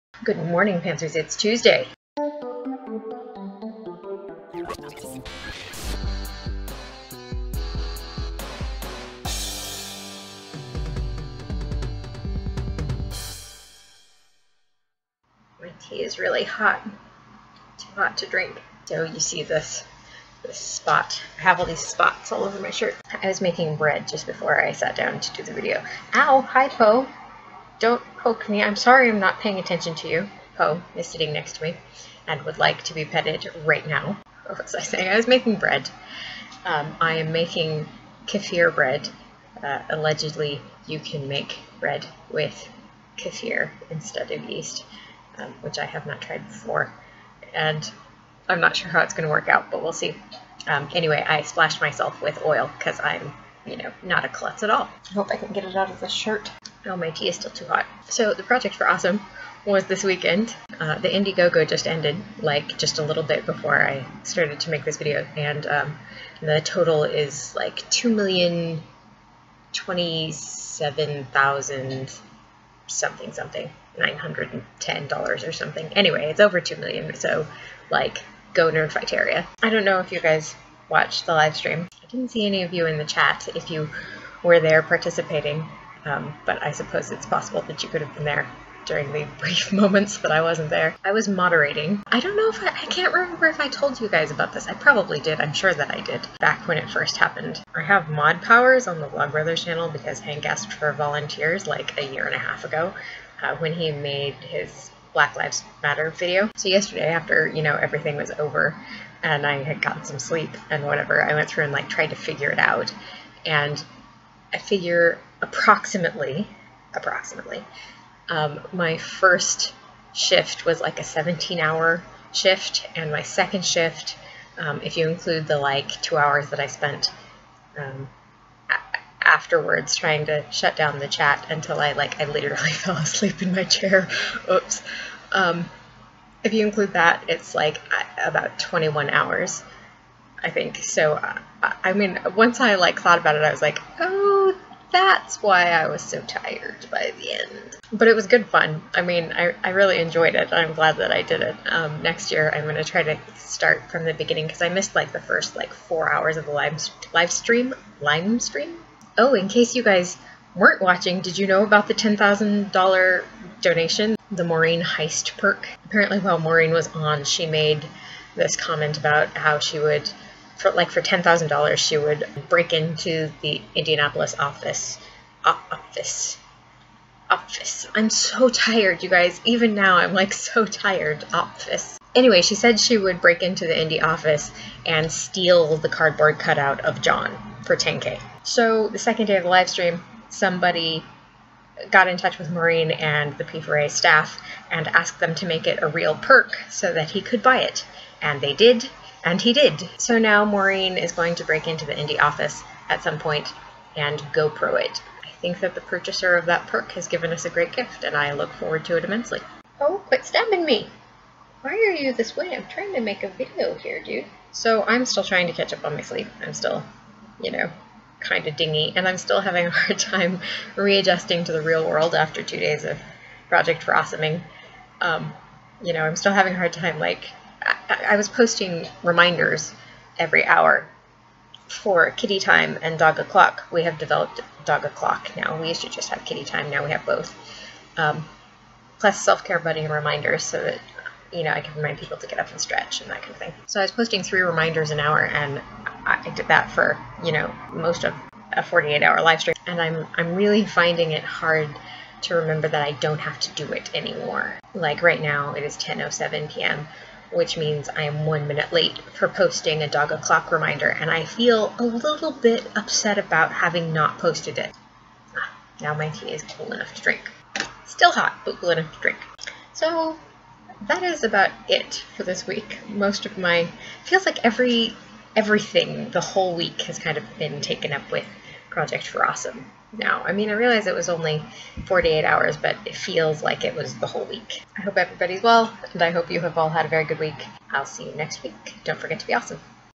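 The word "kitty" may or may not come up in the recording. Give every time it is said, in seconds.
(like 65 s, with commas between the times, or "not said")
232 s, 236 s.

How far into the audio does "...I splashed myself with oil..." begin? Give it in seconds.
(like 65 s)
51 s.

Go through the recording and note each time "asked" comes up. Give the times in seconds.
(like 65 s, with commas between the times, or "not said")
100 s, 194 s.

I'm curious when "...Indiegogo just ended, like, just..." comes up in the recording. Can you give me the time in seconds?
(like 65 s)
61 s.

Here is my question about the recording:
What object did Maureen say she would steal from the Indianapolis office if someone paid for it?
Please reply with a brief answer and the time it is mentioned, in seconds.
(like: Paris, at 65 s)
Cardboard cutout of John, at 185 s.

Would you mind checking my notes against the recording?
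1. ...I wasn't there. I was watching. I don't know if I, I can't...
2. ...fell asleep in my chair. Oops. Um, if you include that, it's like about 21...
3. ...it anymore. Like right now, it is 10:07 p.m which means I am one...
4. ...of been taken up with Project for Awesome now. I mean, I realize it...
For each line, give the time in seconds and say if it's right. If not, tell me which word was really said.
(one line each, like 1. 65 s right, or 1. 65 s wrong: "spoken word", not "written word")
1. 90 s wrong: "moderating", not "watching"
2. 132 s right
3. 253 s right
4. 277 s right.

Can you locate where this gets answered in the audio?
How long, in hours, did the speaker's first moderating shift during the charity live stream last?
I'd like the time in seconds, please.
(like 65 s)
121 s.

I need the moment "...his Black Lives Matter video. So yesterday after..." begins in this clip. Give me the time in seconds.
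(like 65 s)
104 s.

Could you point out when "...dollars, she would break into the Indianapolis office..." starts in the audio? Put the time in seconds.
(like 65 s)
171 s.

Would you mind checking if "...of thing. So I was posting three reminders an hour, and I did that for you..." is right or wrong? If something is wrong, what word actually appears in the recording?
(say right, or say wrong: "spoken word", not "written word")
right.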